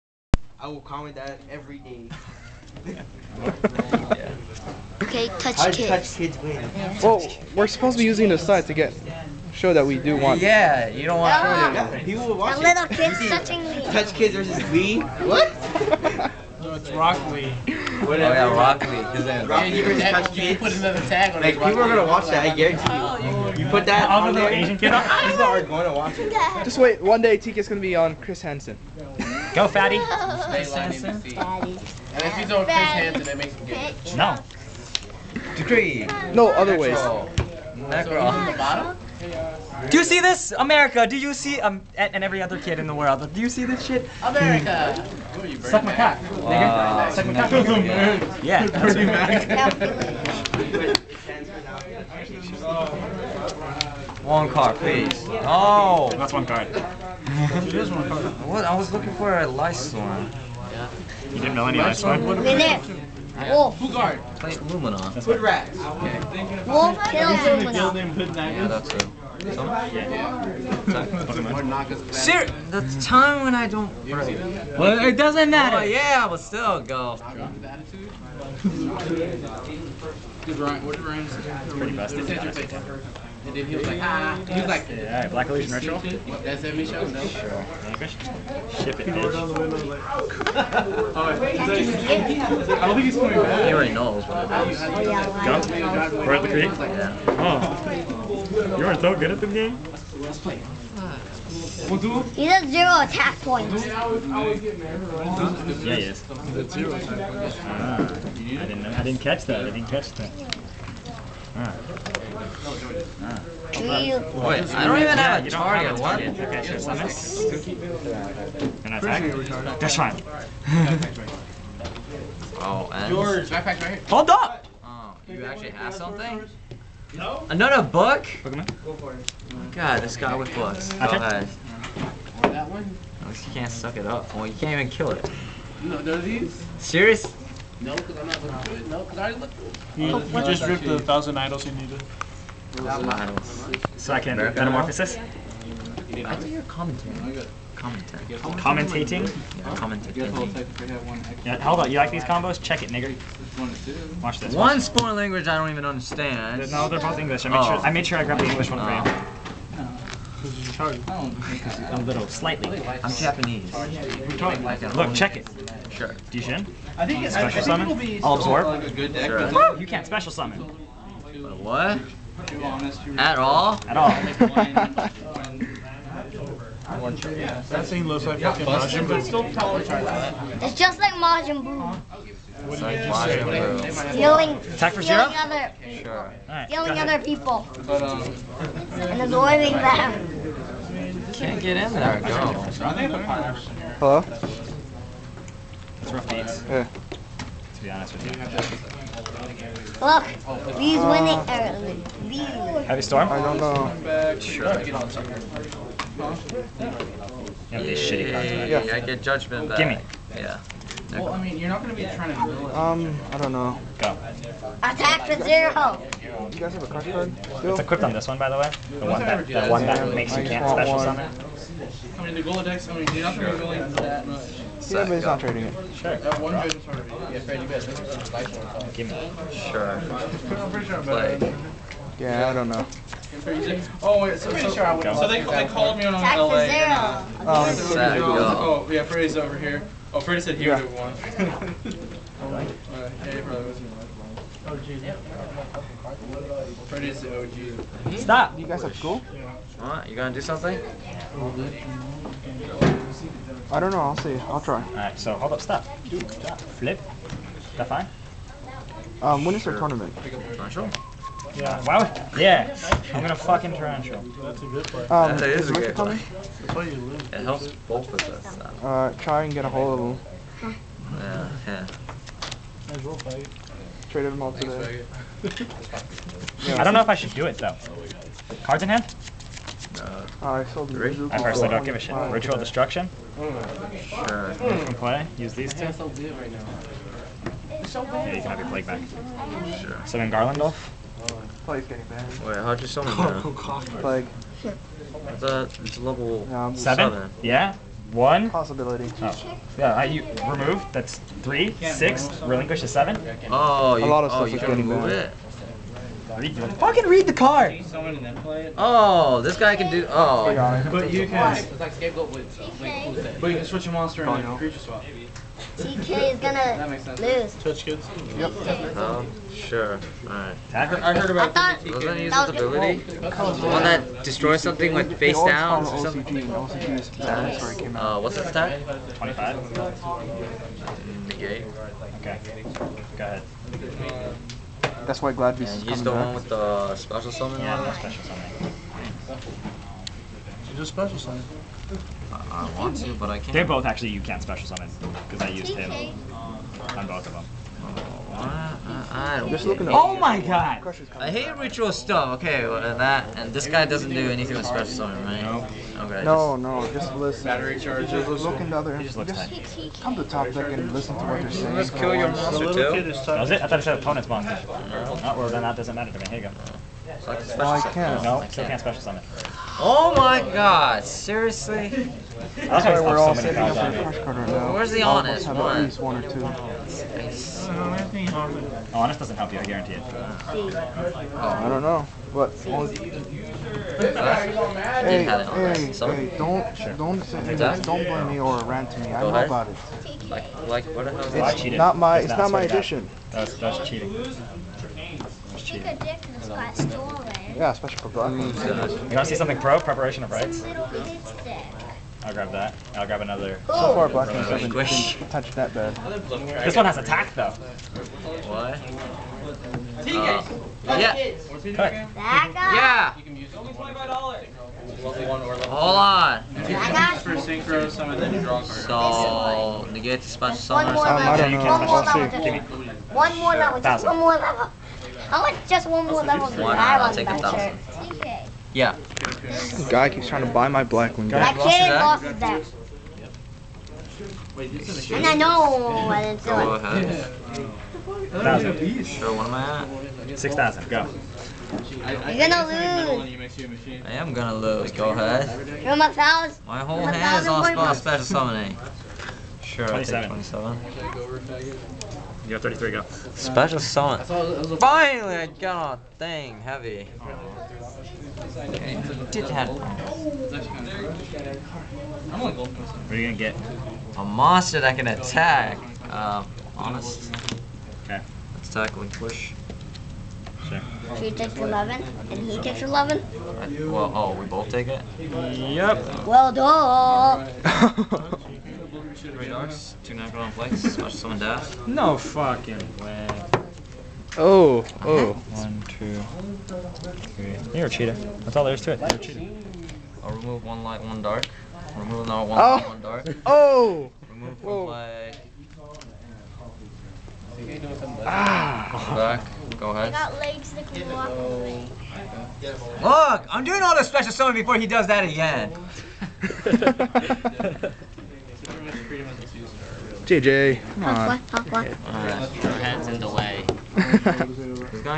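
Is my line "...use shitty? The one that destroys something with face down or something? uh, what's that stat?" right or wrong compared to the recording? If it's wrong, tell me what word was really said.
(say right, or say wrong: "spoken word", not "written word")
wrong: "ability", not "shitty".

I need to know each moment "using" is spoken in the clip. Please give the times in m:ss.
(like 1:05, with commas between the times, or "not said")
0:08.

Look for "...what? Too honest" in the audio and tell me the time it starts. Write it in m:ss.
2:51.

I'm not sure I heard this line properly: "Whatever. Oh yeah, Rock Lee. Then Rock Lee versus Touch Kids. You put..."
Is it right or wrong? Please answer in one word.
right.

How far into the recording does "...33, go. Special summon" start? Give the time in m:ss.
7:32.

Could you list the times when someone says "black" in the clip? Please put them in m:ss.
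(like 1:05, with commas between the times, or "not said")
1:25, 6:44, 7:10.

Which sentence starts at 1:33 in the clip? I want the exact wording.
He already knows what it is.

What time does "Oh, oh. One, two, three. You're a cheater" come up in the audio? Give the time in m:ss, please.
8:04.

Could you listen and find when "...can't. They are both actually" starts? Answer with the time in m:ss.
5:43.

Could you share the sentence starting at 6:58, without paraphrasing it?
So, negate special summon or something.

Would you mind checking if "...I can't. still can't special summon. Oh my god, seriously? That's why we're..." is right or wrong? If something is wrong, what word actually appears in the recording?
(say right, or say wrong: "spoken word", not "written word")
right.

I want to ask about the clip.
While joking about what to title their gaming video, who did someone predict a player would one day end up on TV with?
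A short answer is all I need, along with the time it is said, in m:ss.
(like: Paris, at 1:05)
Chris Hansen, at 0:28.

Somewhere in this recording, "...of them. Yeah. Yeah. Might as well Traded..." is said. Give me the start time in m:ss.
4:29.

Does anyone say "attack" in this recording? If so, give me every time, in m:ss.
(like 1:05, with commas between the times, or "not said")
1:43, 1:59, 3:04, 3:34, 6:46, 7:45.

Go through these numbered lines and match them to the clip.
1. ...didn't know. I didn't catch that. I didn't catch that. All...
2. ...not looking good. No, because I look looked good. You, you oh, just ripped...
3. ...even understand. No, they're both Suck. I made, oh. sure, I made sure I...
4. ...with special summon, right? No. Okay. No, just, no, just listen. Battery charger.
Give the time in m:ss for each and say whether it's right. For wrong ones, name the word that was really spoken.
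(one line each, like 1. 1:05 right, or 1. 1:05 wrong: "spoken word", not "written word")
1. 1:48 right
2. 2:18 right
3. 2:35 wrong: "English", not "Suck"
4. 5:54 right.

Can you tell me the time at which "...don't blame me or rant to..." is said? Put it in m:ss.
6:27.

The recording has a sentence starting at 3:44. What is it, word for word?
Yeah, but he's not trading it.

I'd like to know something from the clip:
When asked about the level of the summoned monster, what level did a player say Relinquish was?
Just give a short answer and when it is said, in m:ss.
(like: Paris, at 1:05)
7, at 5:02.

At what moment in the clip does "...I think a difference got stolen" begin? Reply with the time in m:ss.
6:35.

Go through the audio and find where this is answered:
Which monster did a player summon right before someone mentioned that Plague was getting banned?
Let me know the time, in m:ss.
4:50.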